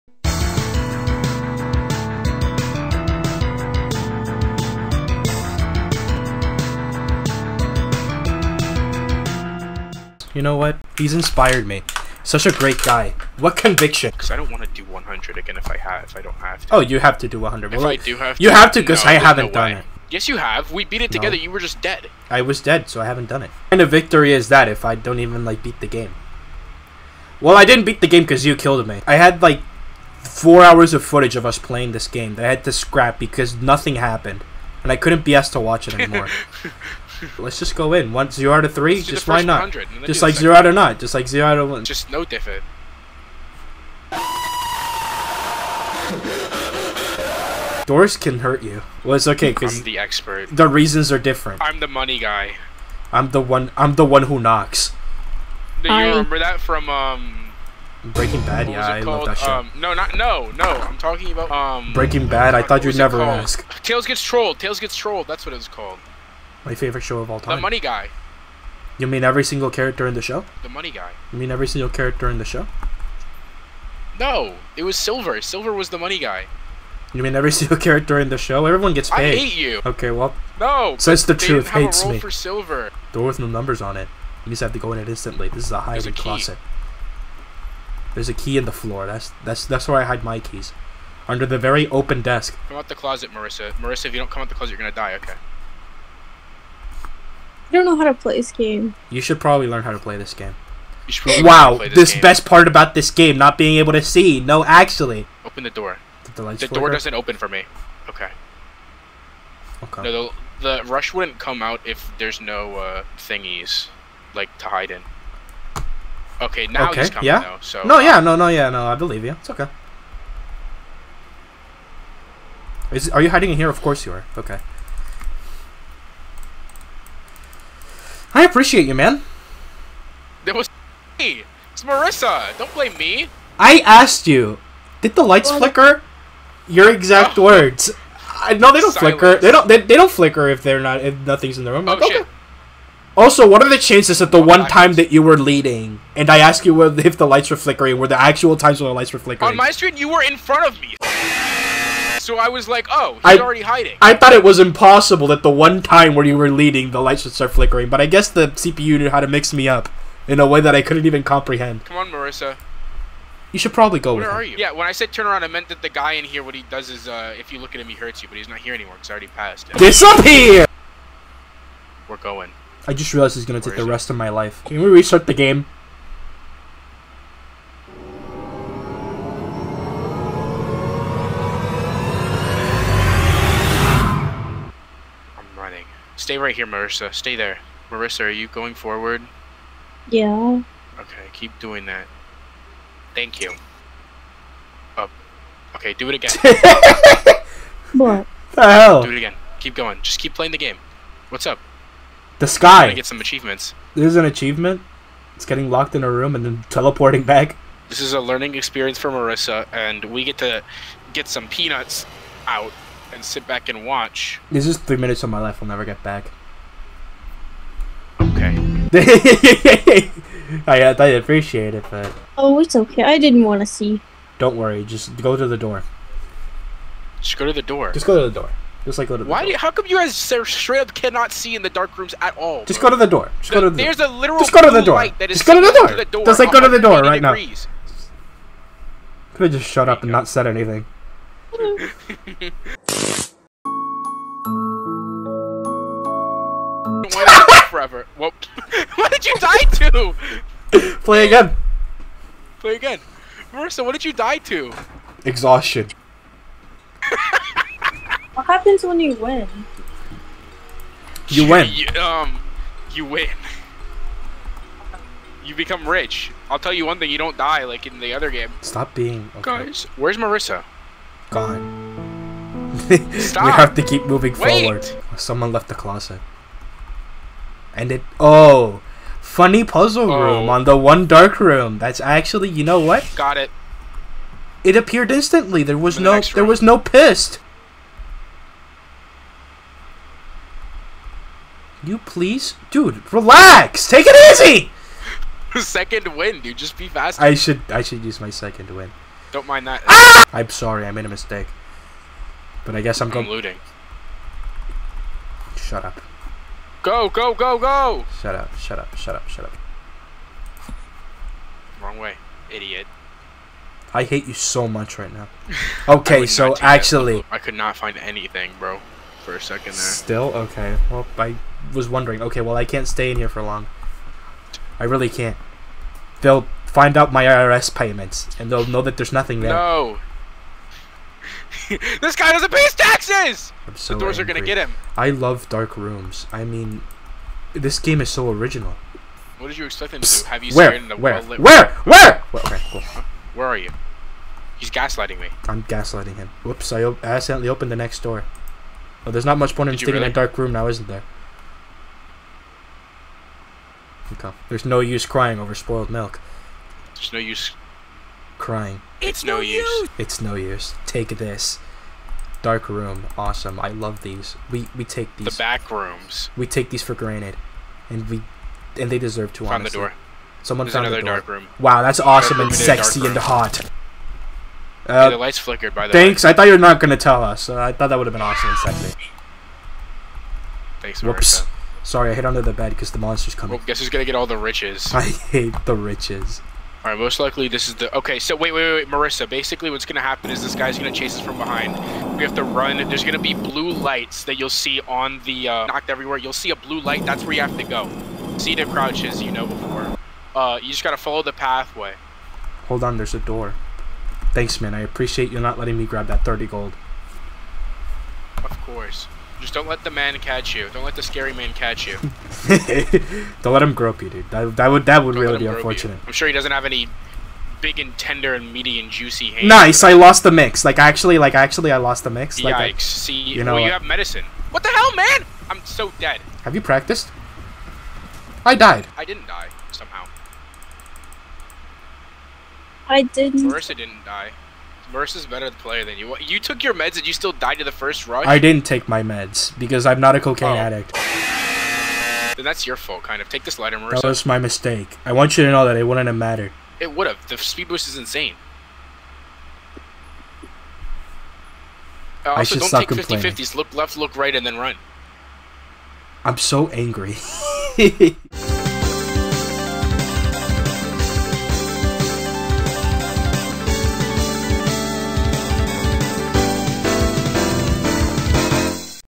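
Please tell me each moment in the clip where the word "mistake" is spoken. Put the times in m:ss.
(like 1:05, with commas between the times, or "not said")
5:01, 7:24.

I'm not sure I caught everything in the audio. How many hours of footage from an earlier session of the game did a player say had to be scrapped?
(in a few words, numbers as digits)
4.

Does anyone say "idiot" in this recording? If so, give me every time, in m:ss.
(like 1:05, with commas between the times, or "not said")
5:12.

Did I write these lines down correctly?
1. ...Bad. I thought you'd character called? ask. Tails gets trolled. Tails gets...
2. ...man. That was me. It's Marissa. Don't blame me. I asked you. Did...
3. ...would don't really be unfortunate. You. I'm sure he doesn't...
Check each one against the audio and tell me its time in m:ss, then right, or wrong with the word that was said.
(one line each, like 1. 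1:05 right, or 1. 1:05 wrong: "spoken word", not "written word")
1. 1:02 wrong: "never", not "character"
2. 2:08 right
3. 6:55 right.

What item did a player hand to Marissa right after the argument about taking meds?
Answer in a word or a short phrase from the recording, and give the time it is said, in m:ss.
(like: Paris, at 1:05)
lighter, at 7:23.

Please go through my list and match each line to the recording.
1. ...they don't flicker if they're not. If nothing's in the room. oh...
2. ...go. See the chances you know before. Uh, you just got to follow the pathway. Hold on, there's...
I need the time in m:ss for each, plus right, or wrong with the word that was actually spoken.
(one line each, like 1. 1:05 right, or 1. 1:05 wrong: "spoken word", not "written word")
1. 2:19 right
2. 6:37 wrong: "crouches", not "chances".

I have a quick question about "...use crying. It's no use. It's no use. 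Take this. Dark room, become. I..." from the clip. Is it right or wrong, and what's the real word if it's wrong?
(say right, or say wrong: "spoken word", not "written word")
wrong: "awesome", not "become".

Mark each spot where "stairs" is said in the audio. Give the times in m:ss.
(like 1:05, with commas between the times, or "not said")
not said.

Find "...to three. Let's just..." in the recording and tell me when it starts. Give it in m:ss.
0:38.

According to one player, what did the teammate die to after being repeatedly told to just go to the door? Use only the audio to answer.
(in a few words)
Exhaustion.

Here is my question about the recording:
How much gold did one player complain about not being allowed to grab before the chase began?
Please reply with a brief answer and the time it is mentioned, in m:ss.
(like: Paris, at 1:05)
30, at 6:46.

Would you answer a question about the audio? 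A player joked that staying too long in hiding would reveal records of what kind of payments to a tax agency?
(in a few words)
IRS payments.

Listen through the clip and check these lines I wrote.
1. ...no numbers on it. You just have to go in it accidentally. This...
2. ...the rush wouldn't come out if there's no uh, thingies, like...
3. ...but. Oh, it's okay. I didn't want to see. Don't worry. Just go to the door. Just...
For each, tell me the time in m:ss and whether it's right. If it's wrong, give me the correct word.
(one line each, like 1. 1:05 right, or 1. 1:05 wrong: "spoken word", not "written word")
1. 1:23 wrong: "instantly", not "accidentally"
2. 1:50 right
3. 3:41 right.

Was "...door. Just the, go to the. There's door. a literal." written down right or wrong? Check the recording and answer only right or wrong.
right.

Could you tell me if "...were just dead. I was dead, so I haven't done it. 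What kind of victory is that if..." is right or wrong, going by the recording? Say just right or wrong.
right.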